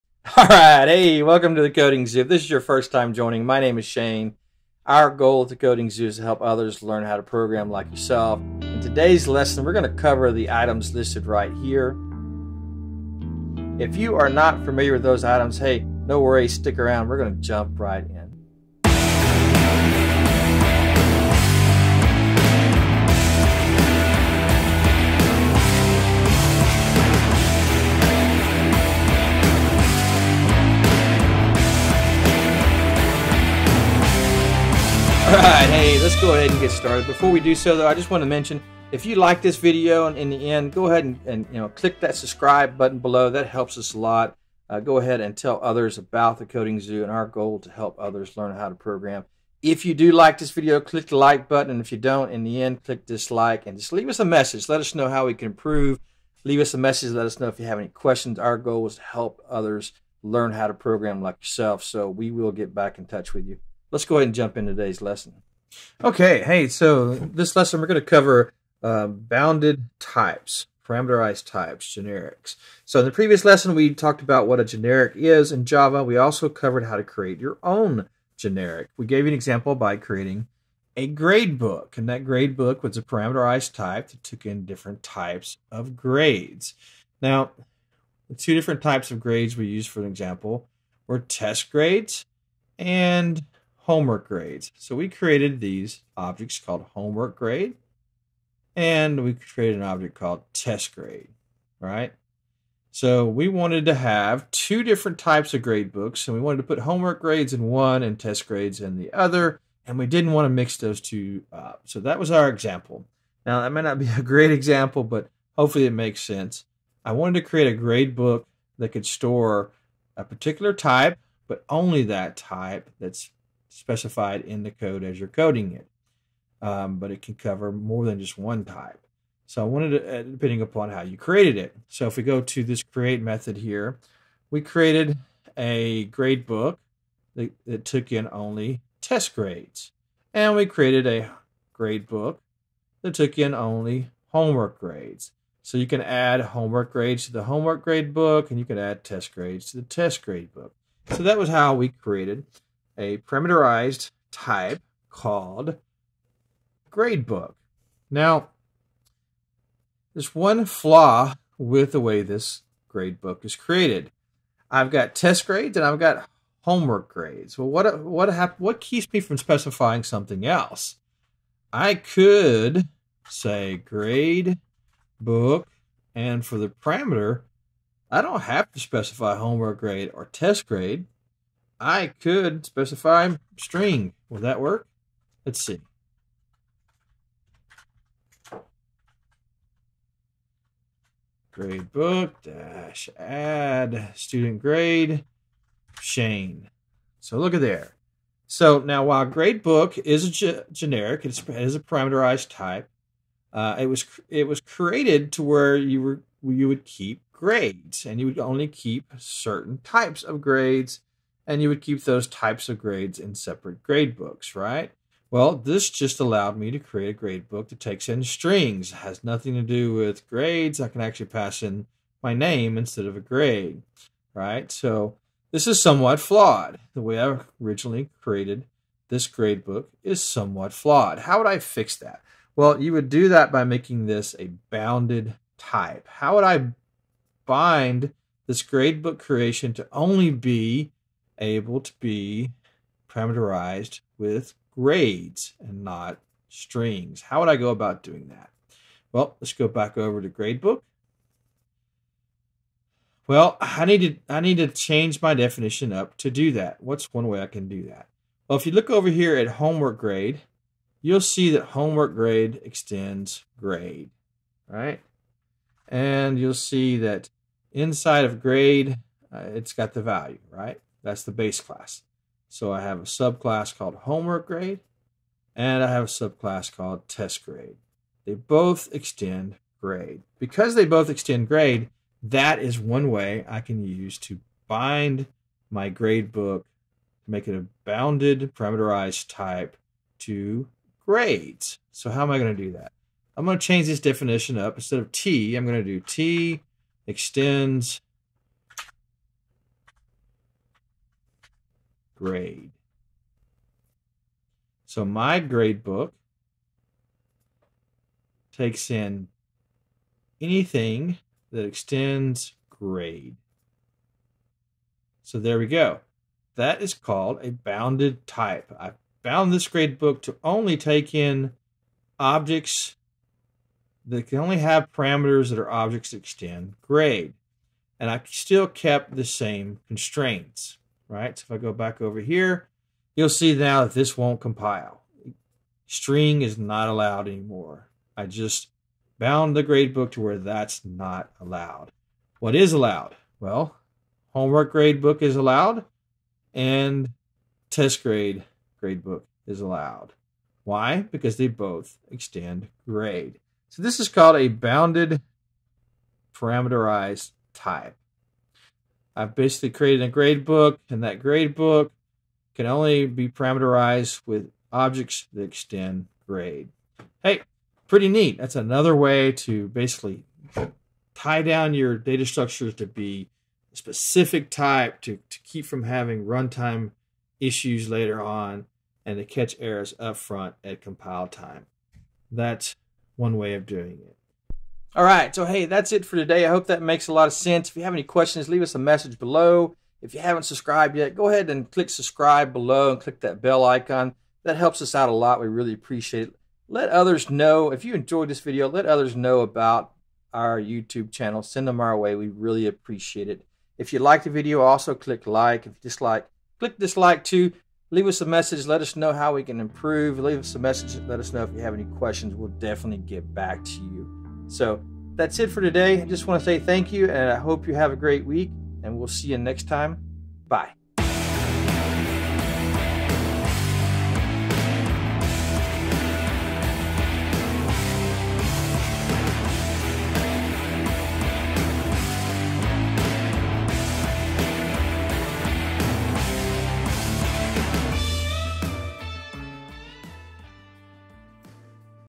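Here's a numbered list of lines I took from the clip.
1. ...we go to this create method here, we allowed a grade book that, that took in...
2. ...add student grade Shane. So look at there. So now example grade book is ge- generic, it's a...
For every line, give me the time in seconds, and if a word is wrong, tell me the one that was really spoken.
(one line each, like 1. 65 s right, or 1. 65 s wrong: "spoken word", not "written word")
1. 132 s wrong: "created", not "allowed"
2. 193 s wrong: "while", not "example".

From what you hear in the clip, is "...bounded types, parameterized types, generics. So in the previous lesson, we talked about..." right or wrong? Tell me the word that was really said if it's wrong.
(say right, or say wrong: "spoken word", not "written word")
right.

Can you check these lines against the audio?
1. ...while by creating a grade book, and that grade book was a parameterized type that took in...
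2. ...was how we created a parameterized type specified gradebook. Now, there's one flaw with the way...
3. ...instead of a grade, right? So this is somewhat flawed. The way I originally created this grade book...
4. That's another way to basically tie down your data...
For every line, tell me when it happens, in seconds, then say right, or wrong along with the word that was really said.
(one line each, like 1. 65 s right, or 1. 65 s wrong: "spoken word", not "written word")
1. 79 s wrong: "example", not "while"
2. 151 s wrong: "called", not "specified"
3. 222 s right
4. 368 s right.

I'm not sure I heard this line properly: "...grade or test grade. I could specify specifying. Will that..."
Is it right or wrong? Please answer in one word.
wrong.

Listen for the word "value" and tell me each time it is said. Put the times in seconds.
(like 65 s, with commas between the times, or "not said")
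270 s.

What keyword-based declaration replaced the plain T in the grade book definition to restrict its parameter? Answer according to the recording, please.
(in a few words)
T extends grade.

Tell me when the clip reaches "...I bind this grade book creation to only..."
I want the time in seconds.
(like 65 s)
236 s.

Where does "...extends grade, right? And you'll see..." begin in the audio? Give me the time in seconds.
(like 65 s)
262 s.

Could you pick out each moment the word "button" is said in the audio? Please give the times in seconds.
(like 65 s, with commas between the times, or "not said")
42 s, 51 s.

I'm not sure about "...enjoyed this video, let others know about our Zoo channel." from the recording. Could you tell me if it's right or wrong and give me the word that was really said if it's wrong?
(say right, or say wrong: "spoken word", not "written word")
wrong: "YouTube", not "Zoo".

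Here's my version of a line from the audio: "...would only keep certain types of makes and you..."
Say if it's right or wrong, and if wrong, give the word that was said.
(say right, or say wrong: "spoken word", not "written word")
wrong: "grades", not "makes".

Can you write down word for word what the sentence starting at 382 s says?
That's one way of doing it.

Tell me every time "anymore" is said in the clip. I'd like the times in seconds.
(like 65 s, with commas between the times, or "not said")
337 s.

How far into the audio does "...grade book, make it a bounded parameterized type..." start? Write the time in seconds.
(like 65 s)
285 s.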